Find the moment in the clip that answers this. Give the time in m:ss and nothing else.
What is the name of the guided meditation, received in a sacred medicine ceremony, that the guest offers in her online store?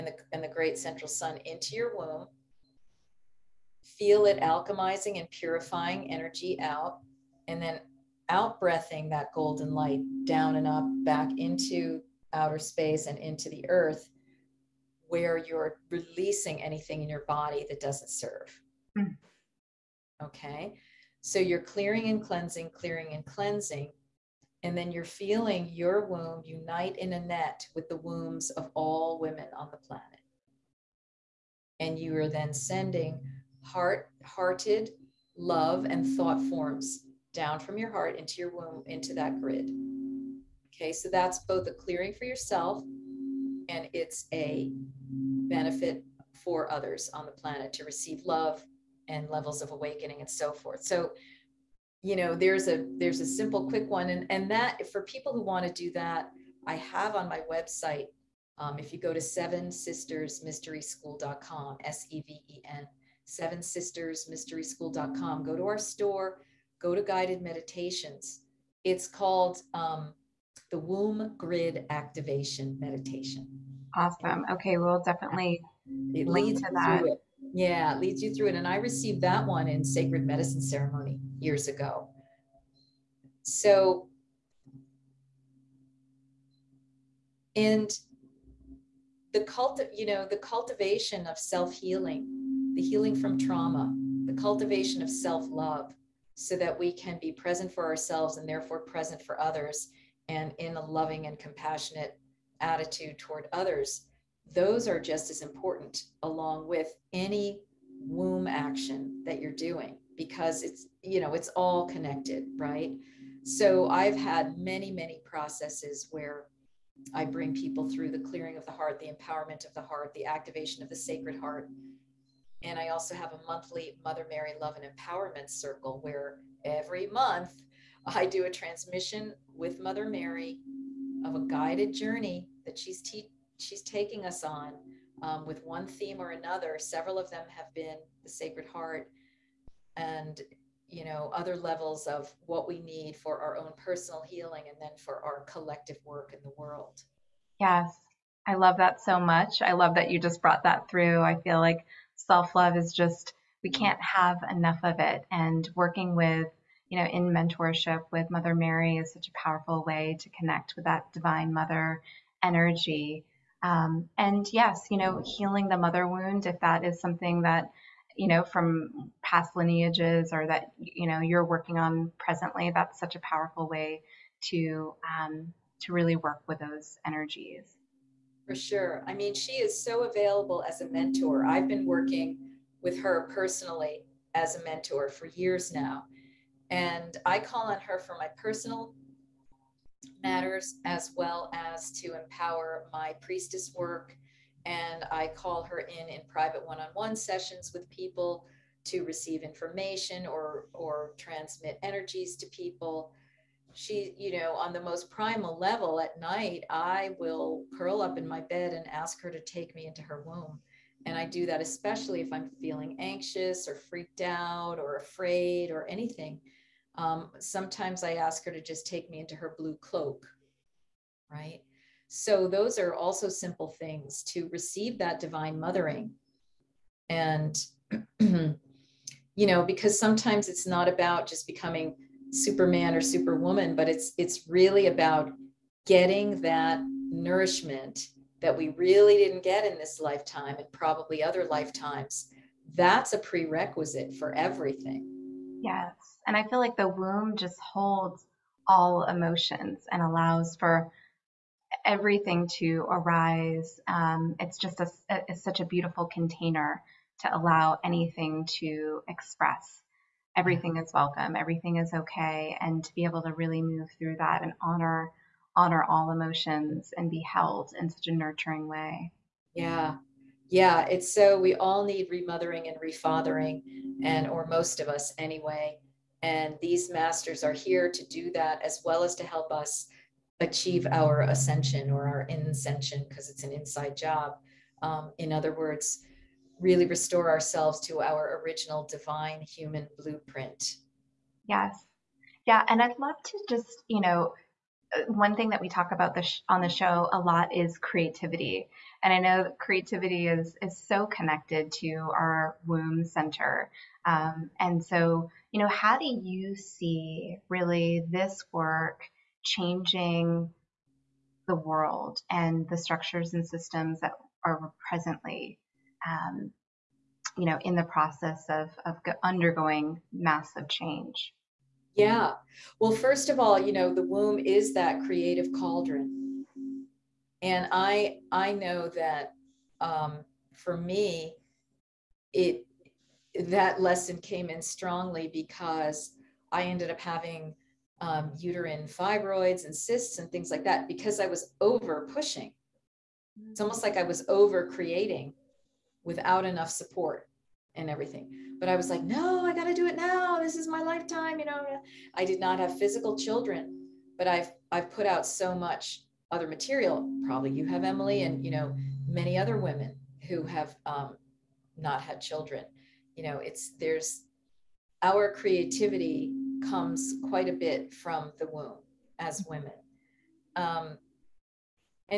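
1:10.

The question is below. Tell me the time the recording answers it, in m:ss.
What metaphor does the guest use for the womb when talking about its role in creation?
5:25.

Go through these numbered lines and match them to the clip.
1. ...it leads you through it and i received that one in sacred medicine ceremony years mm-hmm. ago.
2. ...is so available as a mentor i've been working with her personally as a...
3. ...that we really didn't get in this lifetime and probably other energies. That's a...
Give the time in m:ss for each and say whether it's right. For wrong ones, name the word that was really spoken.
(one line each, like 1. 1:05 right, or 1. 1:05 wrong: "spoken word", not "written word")
1. 1:17 right
2. 2:59 right
3. 3:58 wrong: "lifetimes", not "energies".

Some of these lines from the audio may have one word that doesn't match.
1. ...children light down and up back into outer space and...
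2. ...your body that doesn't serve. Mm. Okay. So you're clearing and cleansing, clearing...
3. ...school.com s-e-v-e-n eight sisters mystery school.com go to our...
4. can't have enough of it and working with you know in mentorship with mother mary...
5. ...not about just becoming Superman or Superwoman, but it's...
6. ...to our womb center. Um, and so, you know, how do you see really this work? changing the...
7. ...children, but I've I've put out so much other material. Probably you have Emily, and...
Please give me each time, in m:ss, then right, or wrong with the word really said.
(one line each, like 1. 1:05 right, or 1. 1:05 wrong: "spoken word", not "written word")
1. 0:09 wrong: "golden", not "children"
2. 0:17 right
3. 1:00 wrong: "seven", not "eight"
4. 2:33 right
5. 3:50 right
6. 5:01 right
7. 5:53 right.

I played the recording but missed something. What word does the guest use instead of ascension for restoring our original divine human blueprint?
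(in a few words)
Inscension.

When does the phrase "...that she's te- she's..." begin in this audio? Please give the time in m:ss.
2:12.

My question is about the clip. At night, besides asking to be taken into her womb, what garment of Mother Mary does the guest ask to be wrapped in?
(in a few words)
Her blue cloak.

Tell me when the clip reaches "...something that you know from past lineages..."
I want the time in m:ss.
2:46.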